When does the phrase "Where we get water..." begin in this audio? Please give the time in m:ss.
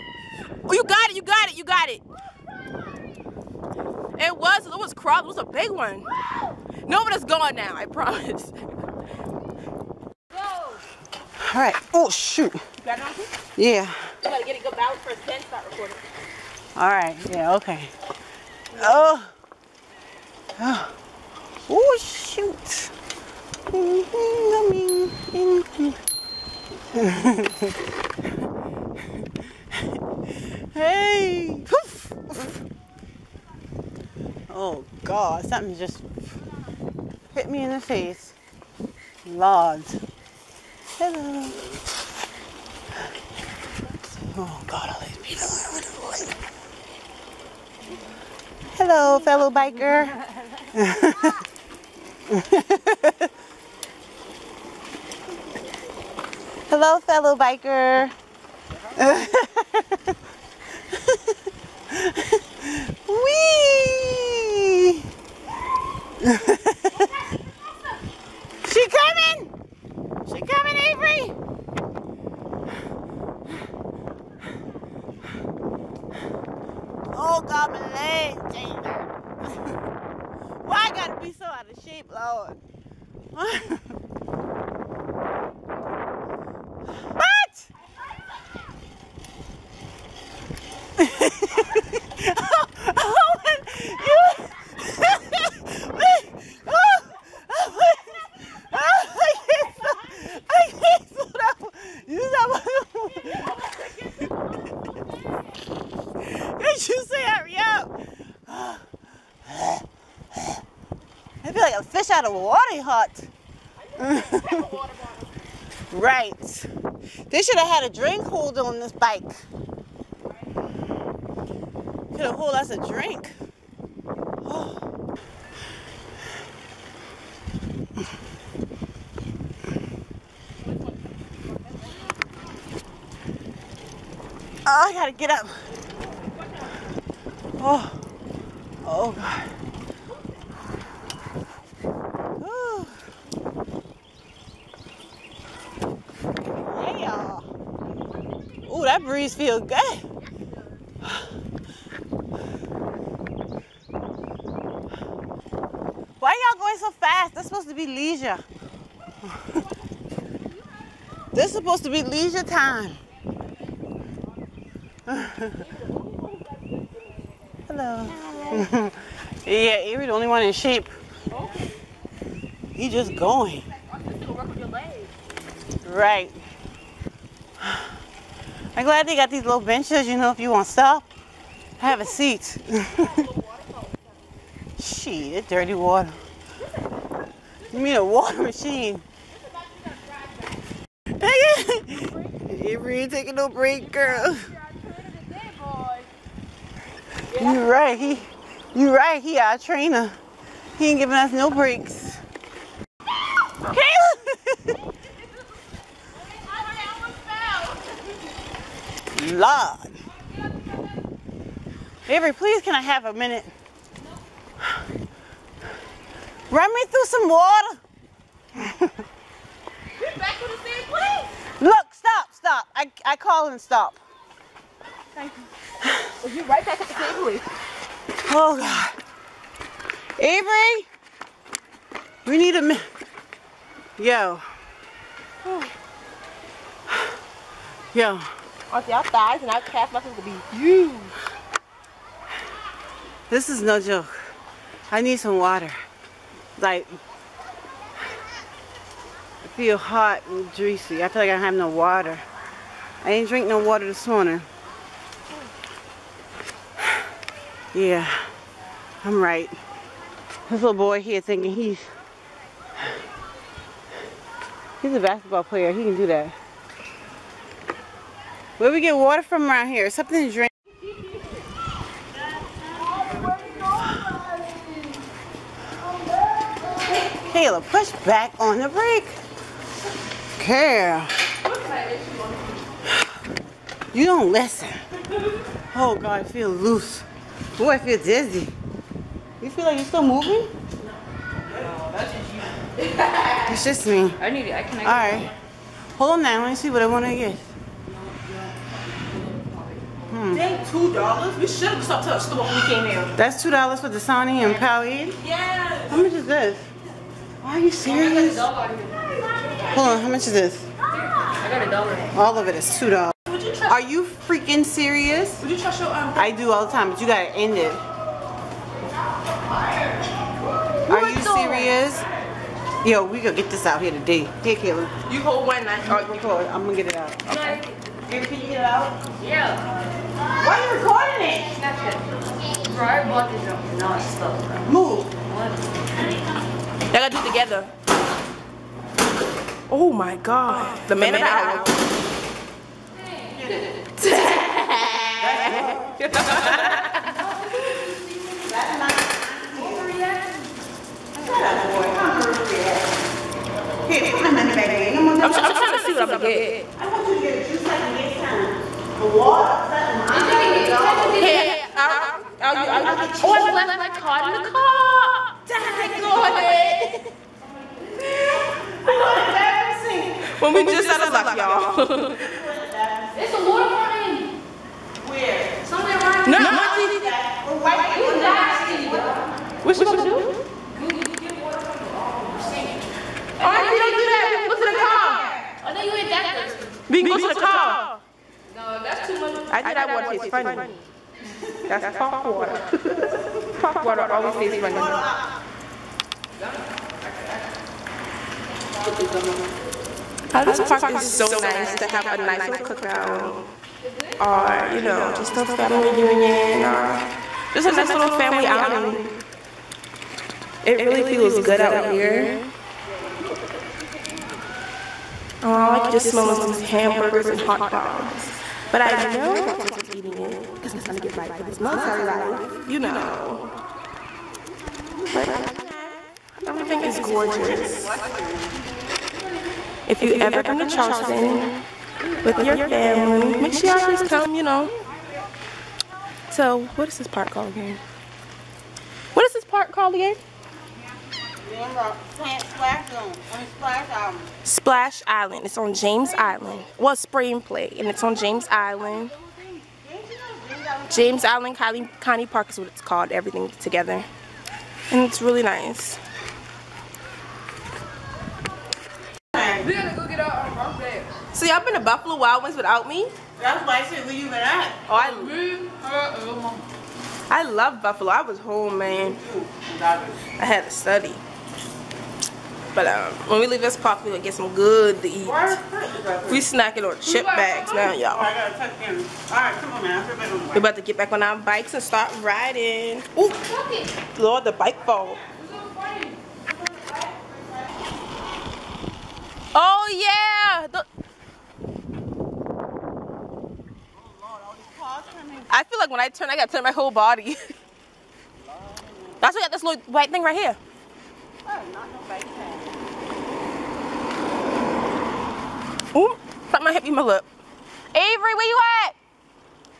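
4:28.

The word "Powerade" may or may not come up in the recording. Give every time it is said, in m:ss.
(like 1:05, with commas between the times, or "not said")
5:04.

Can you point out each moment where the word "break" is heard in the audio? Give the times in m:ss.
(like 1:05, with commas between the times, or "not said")
3:13, 3:21.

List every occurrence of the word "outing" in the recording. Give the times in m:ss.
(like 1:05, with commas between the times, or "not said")
6:48.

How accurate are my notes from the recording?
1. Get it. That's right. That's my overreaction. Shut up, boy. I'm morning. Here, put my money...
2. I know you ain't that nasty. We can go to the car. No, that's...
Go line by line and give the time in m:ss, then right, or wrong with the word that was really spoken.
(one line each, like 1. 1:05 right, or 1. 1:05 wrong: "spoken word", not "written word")
1. 5:43 wrong: "overreacting", not "morning"
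2. 6:25 wrong: "thirsty", not "nasty".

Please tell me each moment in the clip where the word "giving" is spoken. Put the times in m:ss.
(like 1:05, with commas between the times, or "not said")
3:20.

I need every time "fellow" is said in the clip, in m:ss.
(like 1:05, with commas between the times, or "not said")
0:49, 0:56.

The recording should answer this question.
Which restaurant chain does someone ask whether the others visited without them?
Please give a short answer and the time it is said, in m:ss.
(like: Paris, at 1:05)
Buffalo Wild Wings, at 7:41.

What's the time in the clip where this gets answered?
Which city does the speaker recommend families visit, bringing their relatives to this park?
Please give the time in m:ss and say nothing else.
7:10.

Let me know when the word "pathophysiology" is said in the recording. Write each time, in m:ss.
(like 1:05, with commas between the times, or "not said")
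not said.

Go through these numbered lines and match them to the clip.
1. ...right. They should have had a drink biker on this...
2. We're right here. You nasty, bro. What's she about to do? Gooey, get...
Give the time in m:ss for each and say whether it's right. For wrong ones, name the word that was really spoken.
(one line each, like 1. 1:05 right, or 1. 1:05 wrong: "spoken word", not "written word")
1. 1:55 wrong: "holder", not "biker"
2. 6:17 right.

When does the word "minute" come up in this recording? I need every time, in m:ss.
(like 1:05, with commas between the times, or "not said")
3:33, 3:52.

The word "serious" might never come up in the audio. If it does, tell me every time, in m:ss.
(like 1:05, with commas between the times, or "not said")
5:07, 5:14, 5:21.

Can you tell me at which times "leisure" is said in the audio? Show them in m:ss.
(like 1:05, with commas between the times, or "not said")
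2:37, 2:42.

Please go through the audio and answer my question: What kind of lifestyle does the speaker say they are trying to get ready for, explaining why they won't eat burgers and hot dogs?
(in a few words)
military life.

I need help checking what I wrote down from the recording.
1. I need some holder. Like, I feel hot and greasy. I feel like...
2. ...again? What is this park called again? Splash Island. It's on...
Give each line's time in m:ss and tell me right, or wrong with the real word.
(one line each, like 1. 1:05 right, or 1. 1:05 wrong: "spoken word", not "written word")
1. 4:04 wrong: "water", not "holder"
2. 7:17 right.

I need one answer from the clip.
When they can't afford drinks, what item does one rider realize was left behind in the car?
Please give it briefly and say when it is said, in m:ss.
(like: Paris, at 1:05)
card, at 6:03.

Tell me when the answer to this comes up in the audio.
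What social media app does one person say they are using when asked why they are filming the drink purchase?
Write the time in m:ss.
5:31.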